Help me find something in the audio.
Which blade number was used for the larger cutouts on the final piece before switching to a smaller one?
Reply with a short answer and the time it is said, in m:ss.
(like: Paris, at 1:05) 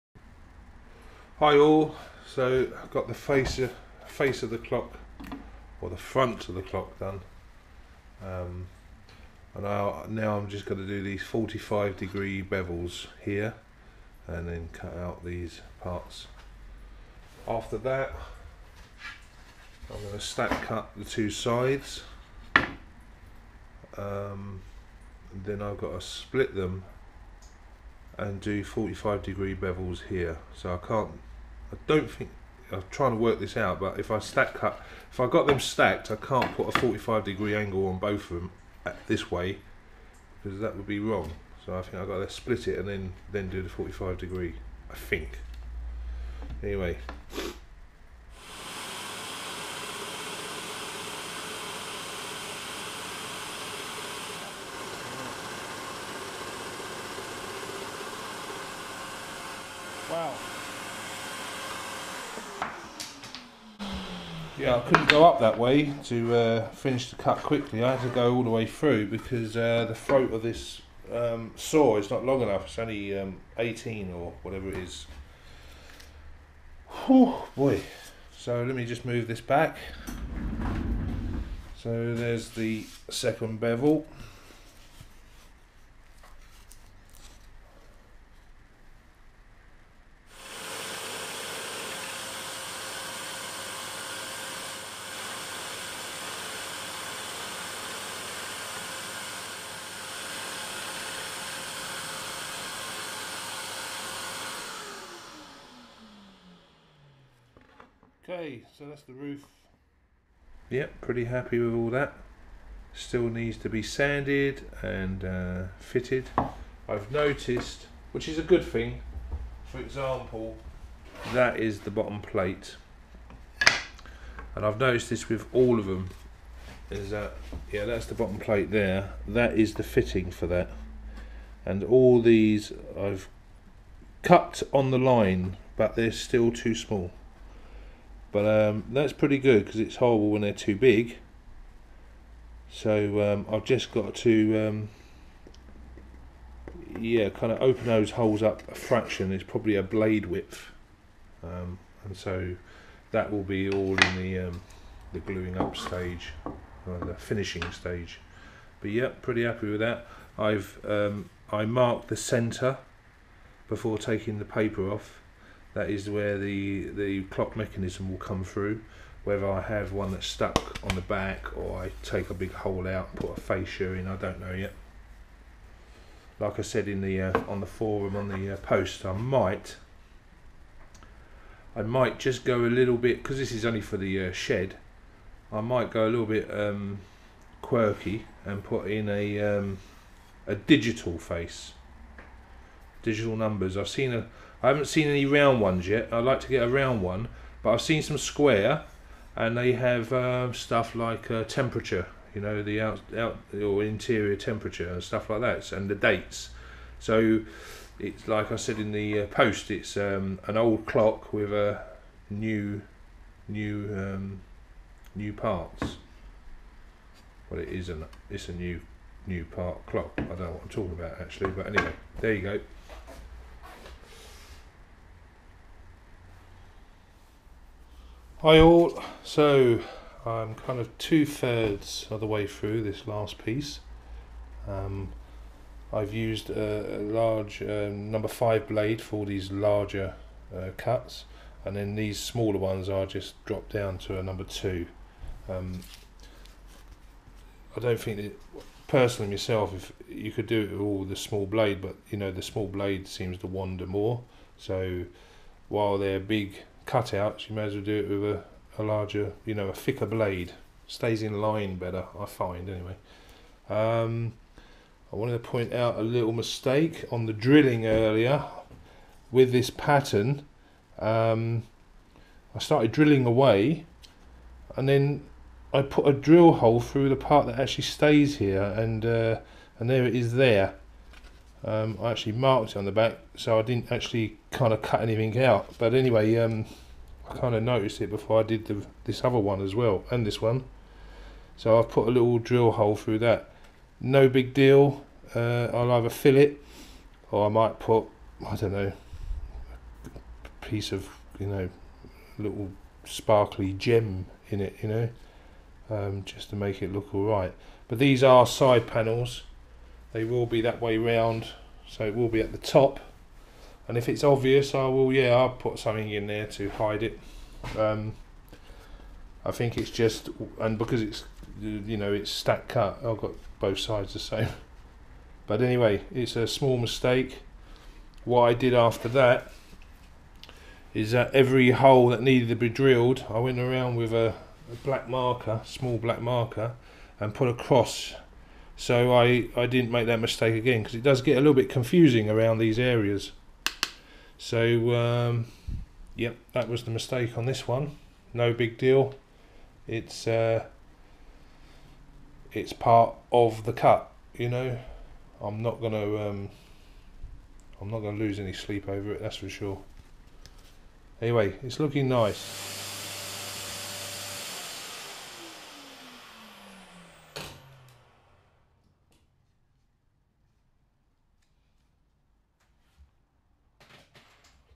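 number 5, at 3:58.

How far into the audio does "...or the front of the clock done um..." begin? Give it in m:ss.
0:05.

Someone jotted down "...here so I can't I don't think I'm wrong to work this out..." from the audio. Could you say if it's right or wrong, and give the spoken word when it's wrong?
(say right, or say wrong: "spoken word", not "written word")
wrong: "trying", not "wrong".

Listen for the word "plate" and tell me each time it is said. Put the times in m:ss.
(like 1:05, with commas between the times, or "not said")
2:02, 2:08.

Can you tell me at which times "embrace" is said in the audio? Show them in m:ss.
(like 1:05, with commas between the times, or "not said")
not said.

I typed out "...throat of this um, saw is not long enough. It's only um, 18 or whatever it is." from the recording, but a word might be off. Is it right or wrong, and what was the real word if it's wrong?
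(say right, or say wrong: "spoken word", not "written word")
right.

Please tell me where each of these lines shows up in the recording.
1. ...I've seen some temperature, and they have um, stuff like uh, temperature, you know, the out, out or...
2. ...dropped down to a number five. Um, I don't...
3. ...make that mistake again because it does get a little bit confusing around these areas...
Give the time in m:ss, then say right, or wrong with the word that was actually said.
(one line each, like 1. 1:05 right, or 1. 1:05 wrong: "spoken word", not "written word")
1. 3:17 wrong: "square", not "temperature"
2. 4:03 wrong: "two", not "five"
3. 5:39 right.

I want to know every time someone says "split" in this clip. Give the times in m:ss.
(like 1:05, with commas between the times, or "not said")
0:26, 0:42.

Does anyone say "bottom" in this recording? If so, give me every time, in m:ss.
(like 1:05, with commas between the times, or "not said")
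2:01, 2:08.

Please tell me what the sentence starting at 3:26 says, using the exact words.
So it's like I said in the uh, post, it's um, an old clock with a new, new, um, new parts.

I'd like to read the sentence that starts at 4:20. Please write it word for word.
Stays in line better, I find, anyway.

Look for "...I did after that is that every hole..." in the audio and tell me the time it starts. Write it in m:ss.
5:28.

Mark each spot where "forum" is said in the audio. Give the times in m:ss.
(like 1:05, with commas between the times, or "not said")
2:57.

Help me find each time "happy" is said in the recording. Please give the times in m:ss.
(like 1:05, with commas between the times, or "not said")
1:51, 2:39.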